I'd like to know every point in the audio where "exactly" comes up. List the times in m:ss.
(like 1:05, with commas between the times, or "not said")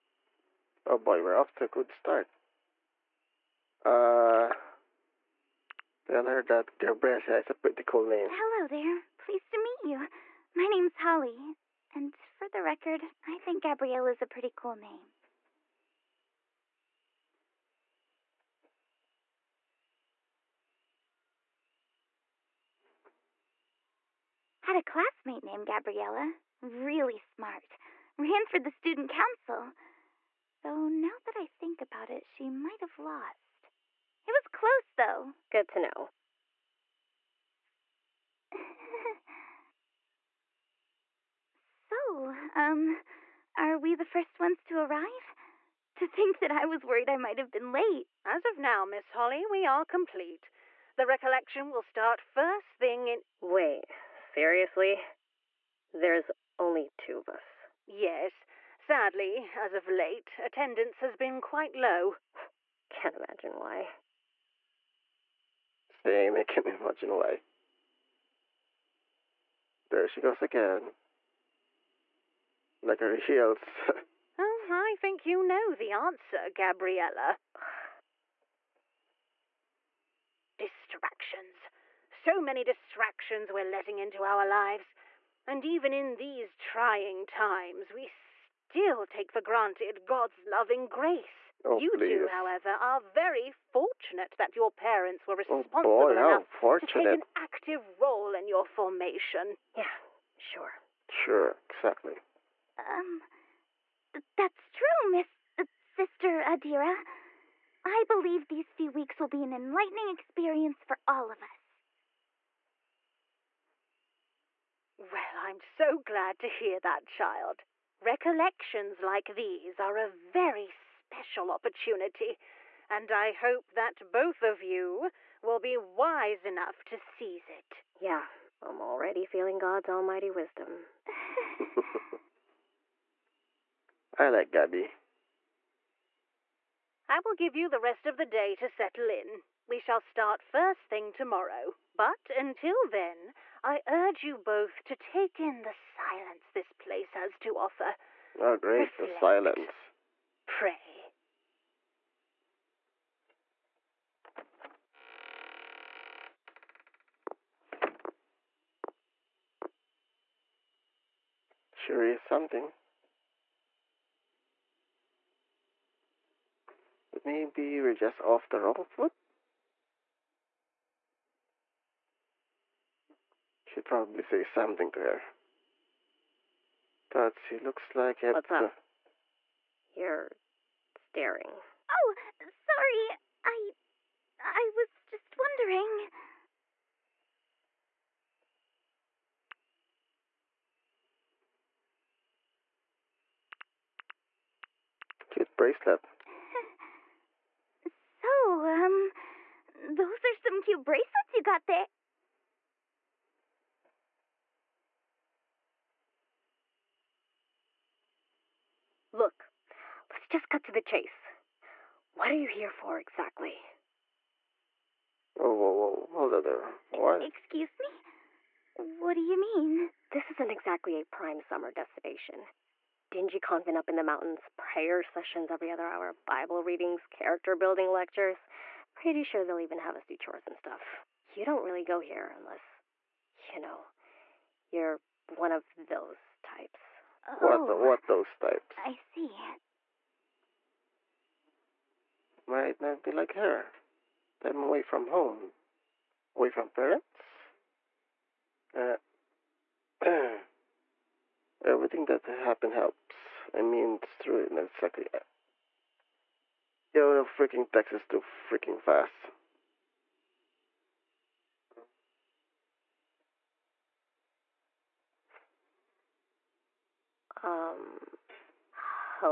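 1:41, 3:32, 3:40, 4:14.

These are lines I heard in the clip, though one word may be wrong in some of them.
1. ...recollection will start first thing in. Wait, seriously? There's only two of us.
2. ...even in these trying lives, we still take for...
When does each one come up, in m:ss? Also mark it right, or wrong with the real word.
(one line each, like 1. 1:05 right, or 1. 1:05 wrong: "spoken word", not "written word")
1. 0:51 right
2. 1:25 wrong: "times", not "lives".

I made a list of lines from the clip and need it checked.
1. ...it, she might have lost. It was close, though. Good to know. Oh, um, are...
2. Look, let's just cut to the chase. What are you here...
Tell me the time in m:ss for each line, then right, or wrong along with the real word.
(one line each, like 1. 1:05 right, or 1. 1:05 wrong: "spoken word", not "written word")
1. 0:32 right
2. 3:29 right.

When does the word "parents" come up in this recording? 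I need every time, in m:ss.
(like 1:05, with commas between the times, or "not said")
1:34, 4:06.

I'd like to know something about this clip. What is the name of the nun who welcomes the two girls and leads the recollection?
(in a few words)
Sister Adira.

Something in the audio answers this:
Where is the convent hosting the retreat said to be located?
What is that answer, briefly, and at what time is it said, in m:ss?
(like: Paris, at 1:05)
Up in the mountains, at 3:43.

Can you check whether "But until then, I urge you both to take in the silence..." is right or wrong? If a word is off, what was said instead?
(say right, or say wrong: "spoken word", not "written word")
right.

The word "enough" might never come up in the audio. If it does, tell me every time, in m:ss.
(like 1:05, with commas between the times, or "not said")
1:36, 2:06.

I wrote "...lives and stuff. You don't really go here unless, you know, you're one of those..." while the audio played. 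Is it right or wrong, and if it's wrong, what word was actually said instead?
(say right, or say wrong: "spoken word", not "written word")
wrong: "chores", not "lives".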